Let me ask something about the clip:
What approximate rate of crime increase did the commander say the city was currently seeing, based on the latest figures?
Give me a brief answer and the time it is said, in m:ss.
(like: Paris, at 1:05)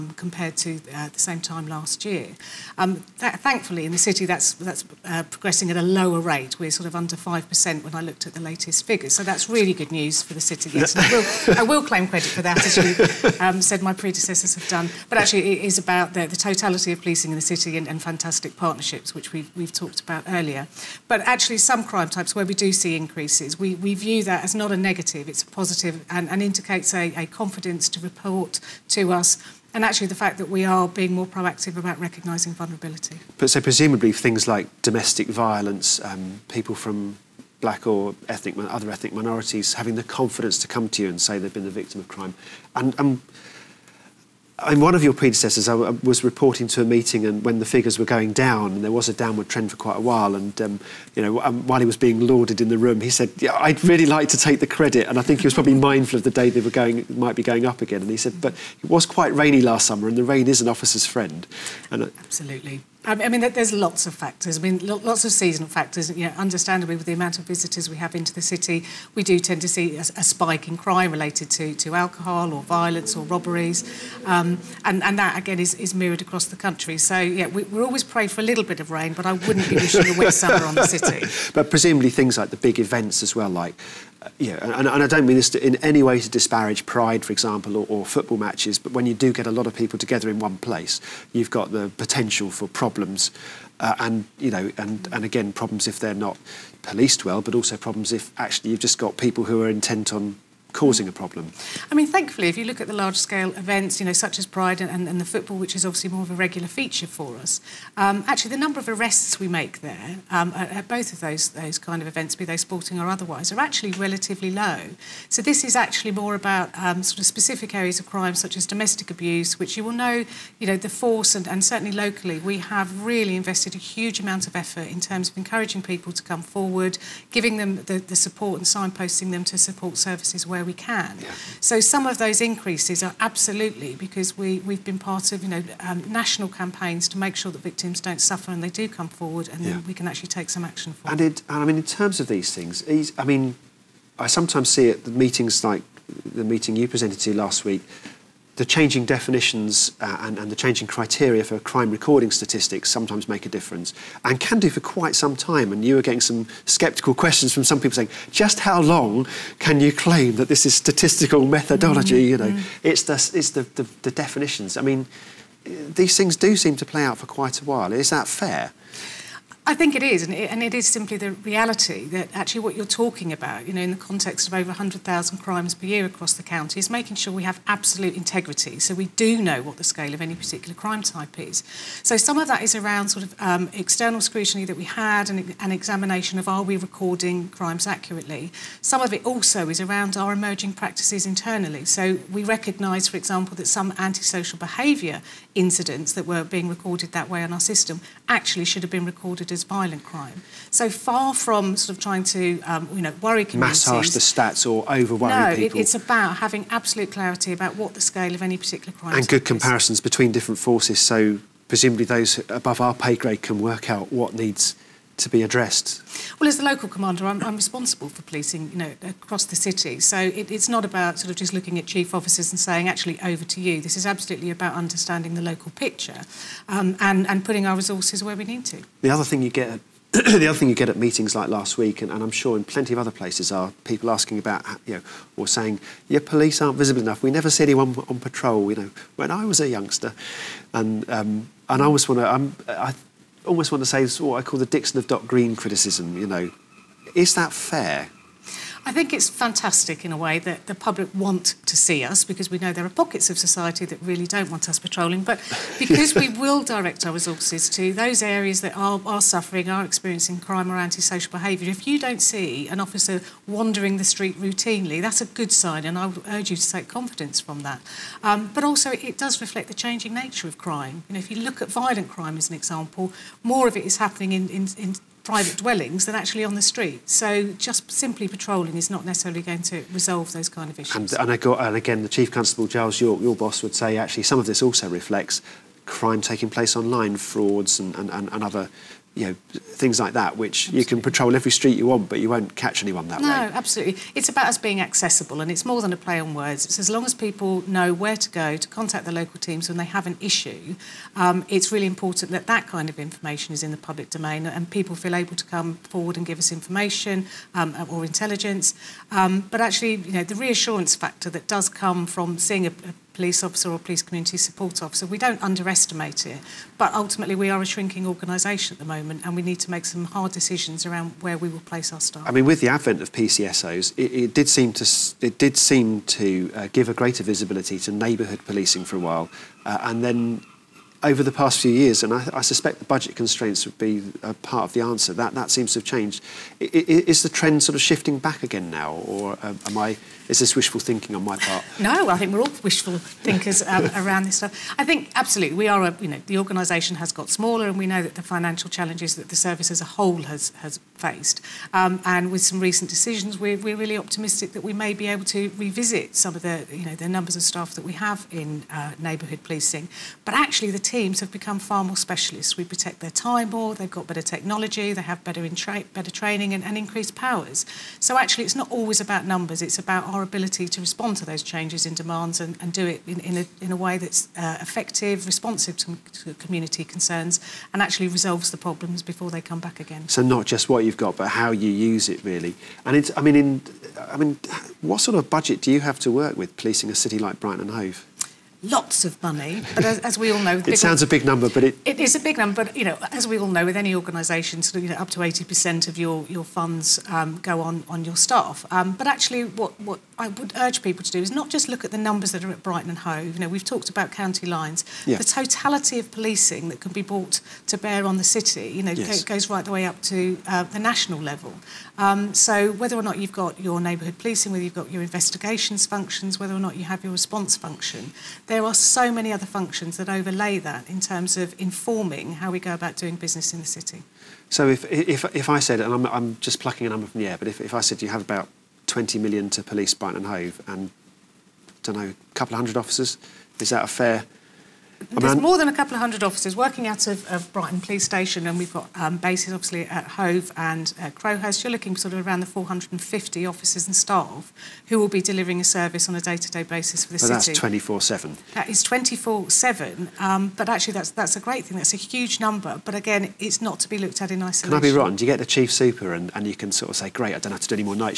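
under 5%, at 0:06.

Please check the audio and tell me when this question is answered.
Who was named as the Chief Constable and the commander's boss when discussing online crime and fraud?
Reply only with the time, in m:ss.
4:42.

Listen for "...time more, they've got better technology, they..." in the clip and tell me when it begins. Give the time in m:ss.
6:03.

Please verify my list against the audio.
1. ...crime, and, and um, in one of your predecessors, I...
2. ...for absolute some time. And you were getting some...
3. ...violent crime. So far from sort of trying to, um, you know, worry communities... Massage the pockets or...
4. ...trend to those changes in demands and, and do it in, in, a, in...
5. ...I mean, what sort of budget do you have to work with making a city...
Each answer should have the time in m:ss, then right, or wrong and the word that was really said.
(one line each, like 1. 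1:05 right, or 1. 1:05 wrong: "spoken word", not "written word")
1. 0:42 right
2. 2:34 wrong: "quite", not "absolute"
3. 3:19 wrong: "stats", not "pockets"
4. 6:10 wrong: "respond", not "trend"
5. 6:23 wrong: "policing", not "making".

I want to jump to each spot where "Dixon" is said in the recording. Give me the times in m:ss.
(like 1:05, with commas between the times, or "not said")
4:04.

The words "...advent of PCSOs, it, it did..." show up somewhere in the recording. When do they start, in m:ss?
5:22.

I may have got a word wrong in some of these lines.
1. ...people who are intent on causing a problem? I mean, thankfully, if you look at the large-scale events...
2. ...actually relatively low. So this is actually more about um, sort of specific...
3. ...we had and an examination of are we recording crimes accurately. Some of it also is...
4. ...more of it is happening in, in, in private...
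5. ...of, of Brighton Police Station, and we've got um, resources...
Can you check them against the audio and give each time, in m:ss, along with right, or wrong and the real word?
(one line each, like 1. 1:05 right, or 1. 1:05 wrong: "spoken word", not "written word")
1. 1:39 right
2. 1:53 right
3. 3:04 right
4. 4:33 right
5. 7:17 wrong: "bases", not "resources".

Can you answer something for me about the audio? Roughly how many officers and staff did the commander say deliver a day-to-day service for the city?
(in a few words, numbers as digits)
450.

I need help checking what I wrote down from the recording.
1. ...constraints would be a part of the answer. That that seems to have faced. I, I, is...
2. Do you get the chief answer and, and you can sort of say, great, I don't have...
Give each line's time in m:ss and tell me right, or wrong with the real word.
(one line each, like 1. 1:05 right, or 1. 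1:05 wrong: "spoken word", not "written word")
1. 5:33 wrong: "changed", not "faced"
2. 7:35 wrong: "super", not "answer".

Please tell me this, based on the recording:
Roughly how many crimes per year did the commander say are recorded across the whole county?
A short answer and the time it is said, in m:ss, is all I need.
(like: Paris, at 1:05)
over 100,000, at 2:54.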